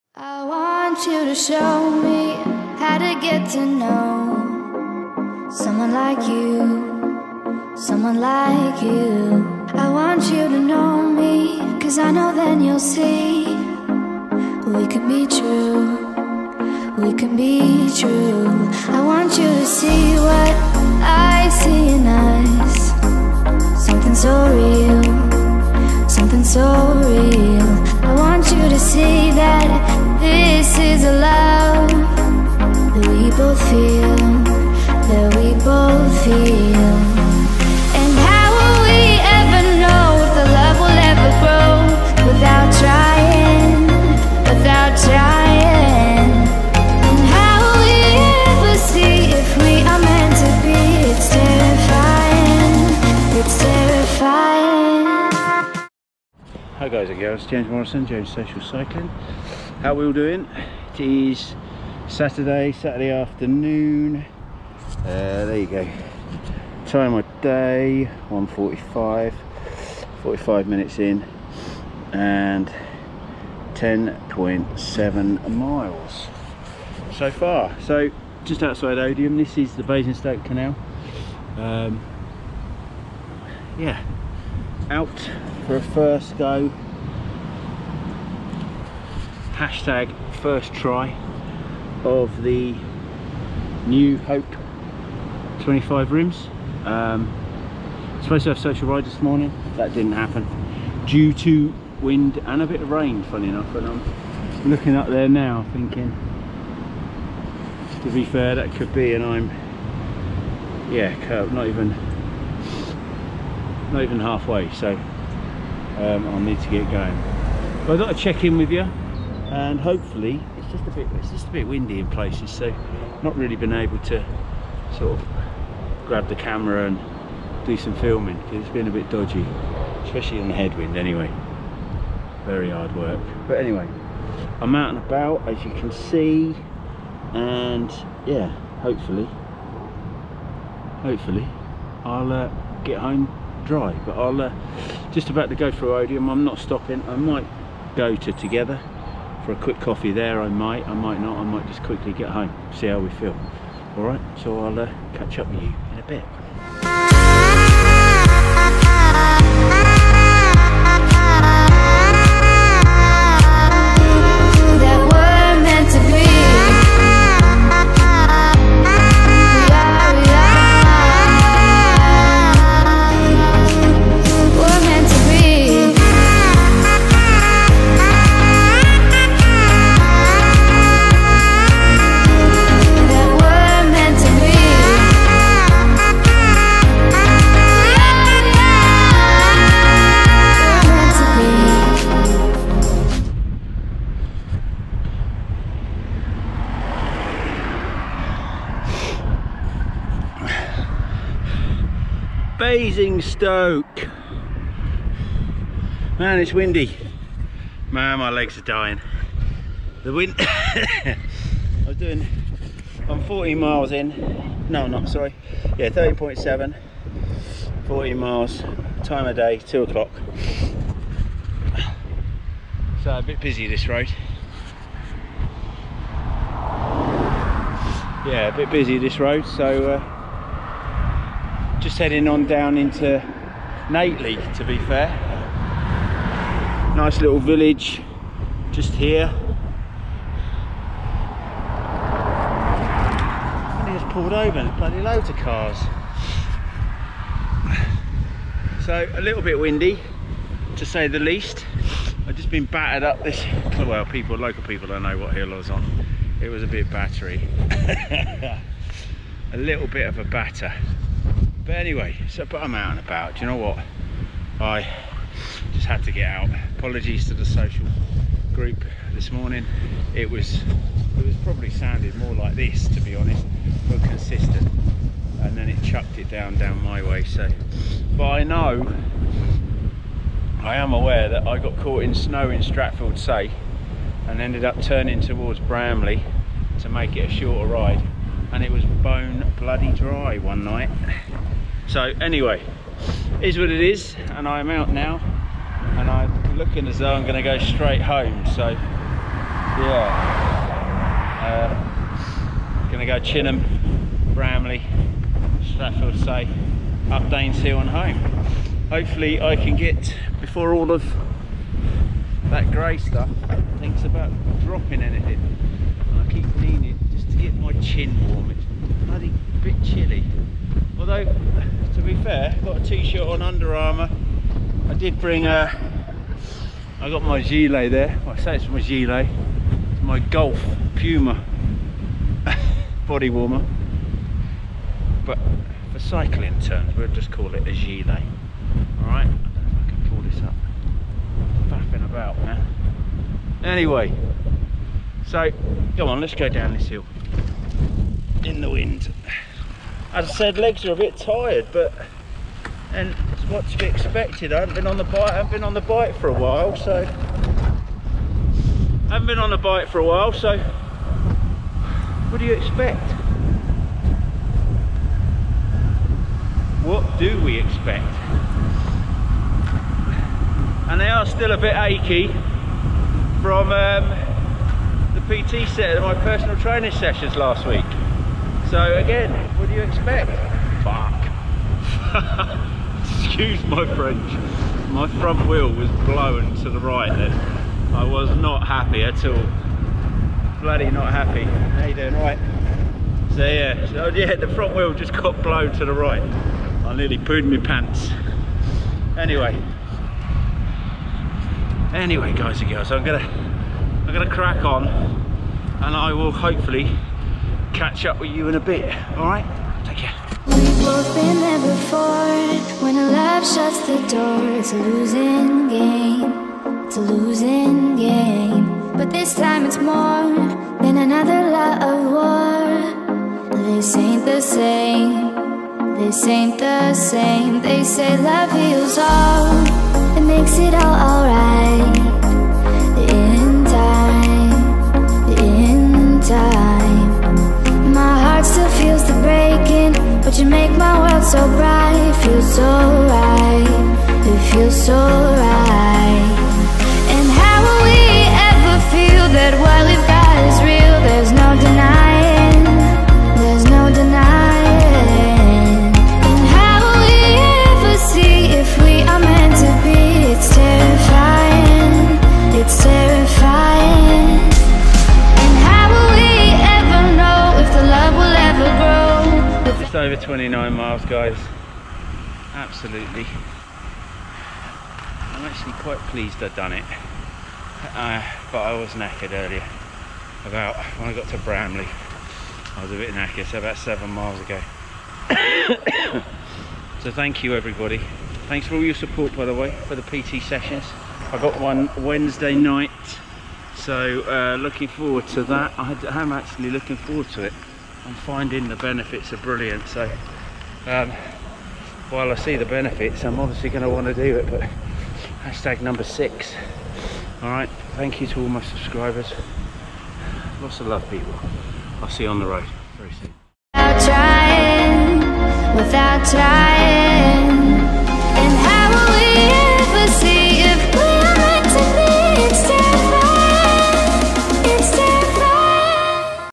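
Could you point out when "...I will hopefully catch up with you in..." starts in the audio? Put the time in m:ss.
6:45.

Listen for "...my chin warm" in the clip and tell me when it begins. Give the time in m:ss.
5:17.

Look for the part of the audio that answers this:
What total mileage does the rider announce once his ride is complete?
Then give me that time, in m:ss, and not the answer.
7:50.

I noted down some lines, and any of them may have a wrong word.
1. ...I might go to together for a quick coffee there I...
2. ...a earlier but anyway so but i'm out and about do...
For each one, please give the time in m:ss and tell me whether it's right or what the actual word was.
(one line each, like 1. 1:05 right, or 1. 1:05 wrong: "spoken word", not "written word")
1. 2:27 right
2. 4:20 wrong: "batter", not "earlier".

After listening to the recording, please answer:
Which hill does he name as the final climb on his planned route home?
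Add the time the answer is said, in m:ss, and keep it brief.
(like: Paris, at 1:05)
Danes Hill, at 5:07.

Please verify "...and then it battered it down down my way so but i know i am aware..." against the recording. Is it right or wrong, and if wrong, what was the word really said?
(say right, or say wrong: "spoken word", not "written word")
wrong: "chucked", not "battered".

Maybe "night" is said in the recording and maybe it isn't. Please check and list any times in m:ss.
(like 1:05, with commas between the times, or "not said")
4:50, 8:12.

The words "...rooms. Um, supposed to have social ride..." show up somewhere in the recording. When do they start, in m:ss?
1:36.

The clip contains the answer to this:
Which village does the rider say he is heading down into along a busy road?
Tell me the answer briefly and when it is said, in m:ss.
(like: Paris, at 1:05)
Nately, at 3:53.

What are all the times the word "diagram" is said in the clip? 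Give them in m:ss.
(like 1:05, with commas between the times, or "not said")
not said.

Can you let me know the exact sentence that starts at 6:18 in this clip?
So again, what do you expect?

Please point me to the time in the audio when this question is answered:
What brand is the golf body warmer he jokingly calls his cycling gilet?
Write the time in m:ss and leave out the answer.
5:30.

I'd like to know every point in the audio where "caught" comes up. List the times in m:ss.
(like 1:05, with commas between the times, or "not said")
4:41.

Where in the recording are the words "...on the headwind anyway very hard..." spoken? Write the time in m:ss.
2:10.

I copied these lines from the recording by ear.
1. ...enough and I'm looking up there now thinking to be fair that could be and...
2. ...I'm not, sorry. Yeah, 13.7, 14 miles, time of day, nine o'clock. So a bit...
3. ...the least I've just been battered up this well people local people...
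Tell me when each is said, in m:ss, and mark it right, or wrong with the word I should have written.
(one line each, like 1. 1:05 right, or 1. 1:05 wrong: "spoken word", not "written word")
1. 1:43 right
2. 3:34 wrong: "two", not "nine"
3. 4:11 right.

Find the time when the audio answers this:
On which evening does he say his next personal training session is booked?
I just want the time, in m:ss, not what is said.
8:11.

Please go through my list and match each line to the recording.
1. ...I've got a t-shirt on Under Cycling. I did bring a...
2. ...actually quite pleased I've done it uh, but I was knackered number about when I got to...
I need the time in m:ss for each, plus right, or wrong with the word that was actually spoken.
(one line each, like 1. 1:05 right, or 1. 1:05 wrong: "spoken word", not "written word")
1. 5:22 wrong: "Armour", not "Cycling"
2. 7:55 wrong: "earlier", not "number".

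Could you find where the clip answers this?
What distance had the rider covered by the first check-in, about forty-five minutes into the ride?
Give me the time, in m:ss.
1:13.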